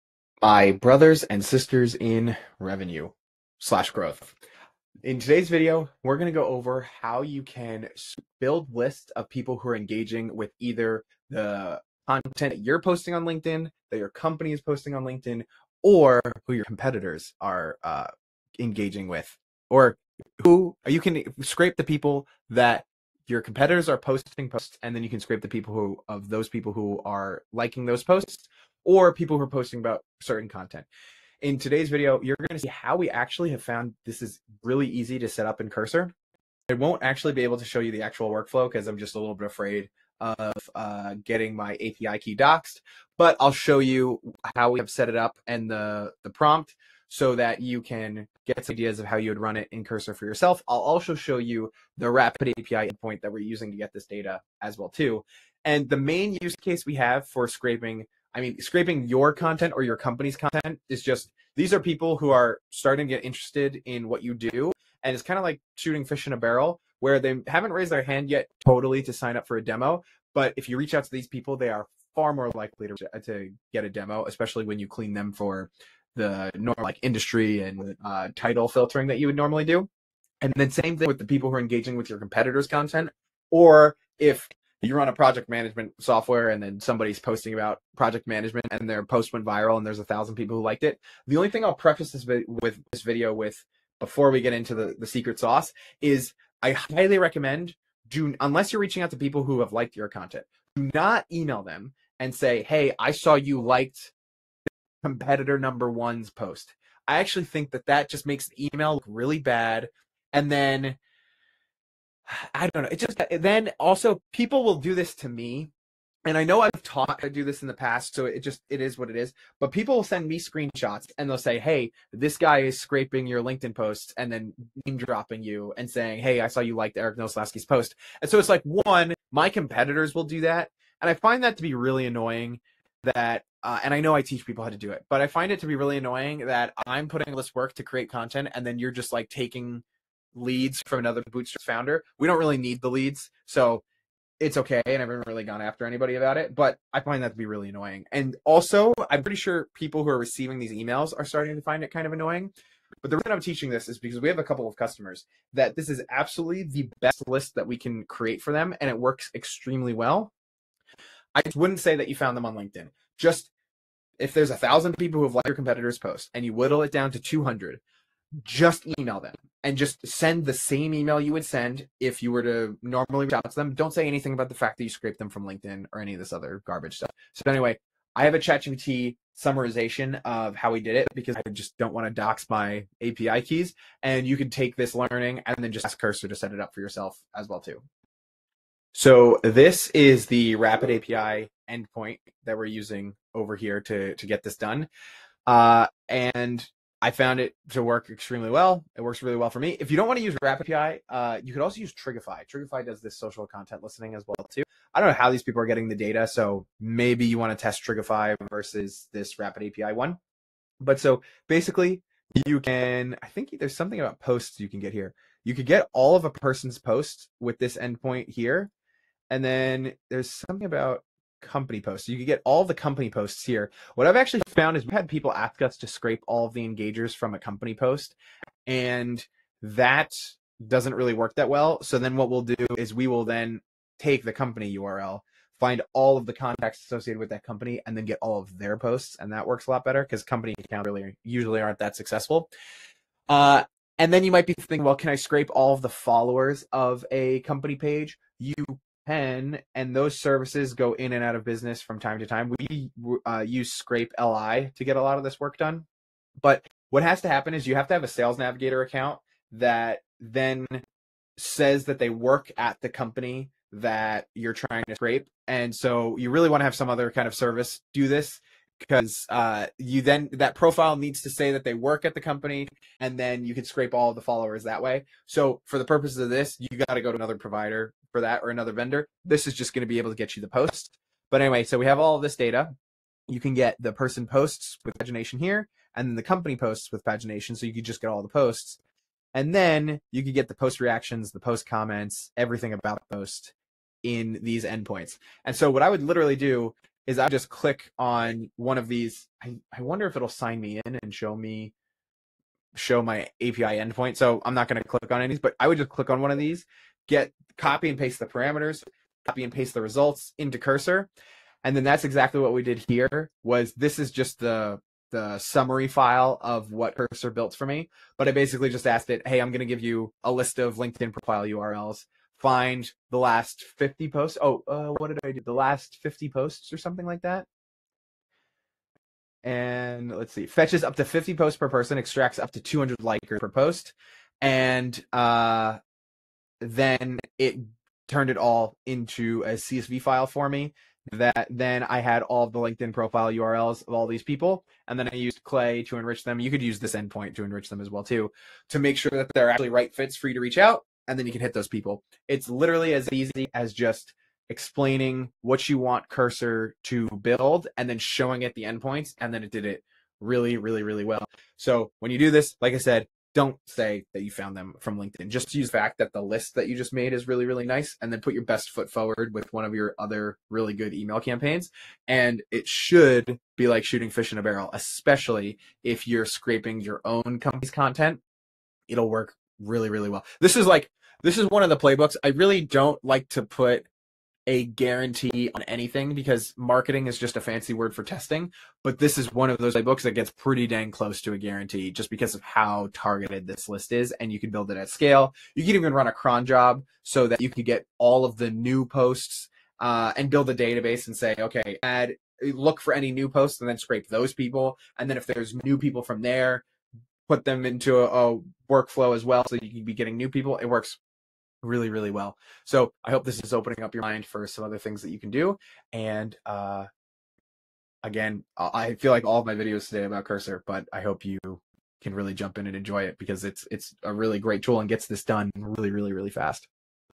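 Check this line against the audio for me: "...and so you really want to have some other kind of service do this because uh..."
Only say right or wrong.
right.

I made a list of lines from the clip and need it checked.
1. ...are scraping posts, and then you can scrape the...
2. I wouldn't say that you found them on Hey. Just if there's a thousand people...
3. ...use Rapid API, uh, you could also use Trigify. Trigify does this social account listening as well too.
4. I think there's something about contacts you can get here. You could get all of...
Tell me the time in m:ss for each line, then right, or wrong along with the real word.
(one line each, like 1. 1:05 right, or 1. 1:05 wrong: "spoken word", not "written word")
1. 0:23 wrong: "posting", not "scraping"
2. 2:41 wrong: "LinkedIn", not "Hey"
3. 3:20 wrong: "content", not "account"
4. 3:33 wrong: "posts", not "contacts".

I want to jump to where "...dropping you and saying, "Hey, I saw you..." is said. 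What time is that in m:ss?
2:04.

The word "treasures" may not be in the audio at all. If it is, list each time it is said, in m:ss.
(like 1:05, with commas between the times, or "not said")
not said.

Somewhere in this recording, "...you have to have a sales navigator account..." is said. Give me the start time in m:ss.
4:17.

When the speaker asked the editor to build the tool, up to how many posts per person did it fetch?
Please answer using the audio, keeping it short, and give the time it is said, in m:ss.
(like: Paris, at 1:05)
50, at 5:31.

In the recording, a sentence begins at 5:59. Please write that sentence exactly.
And then it did it really, really, really well.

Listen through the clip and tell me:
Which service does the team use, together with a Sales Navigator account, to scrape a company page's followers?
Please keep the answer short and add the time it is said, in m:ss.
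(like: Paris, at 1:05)
Scrape li, at 4:13.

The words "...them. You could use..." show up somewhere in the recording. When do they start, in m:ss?
5:46.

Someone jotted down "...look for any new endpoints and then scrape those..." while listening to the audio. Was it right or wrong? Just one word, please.
wrong.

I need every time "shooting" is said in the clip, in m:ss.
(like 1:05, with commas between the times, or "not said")
1:05, 6:13.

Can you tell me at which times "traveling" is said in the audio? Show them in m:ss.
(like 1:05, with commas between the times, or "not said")
not said.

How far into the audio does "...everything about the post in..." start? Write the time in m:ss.
4:52.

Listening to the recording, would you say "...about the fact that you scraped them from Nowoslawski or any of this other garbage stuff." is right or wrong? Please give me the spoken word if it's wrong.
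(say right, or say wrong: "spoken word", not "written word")
wrong: "LinkedIn", not "Nowoslawski".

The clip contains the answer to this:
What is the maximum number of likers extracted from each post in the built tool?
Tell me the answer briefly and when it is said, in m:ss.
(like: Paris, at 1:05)
200, at 5:32.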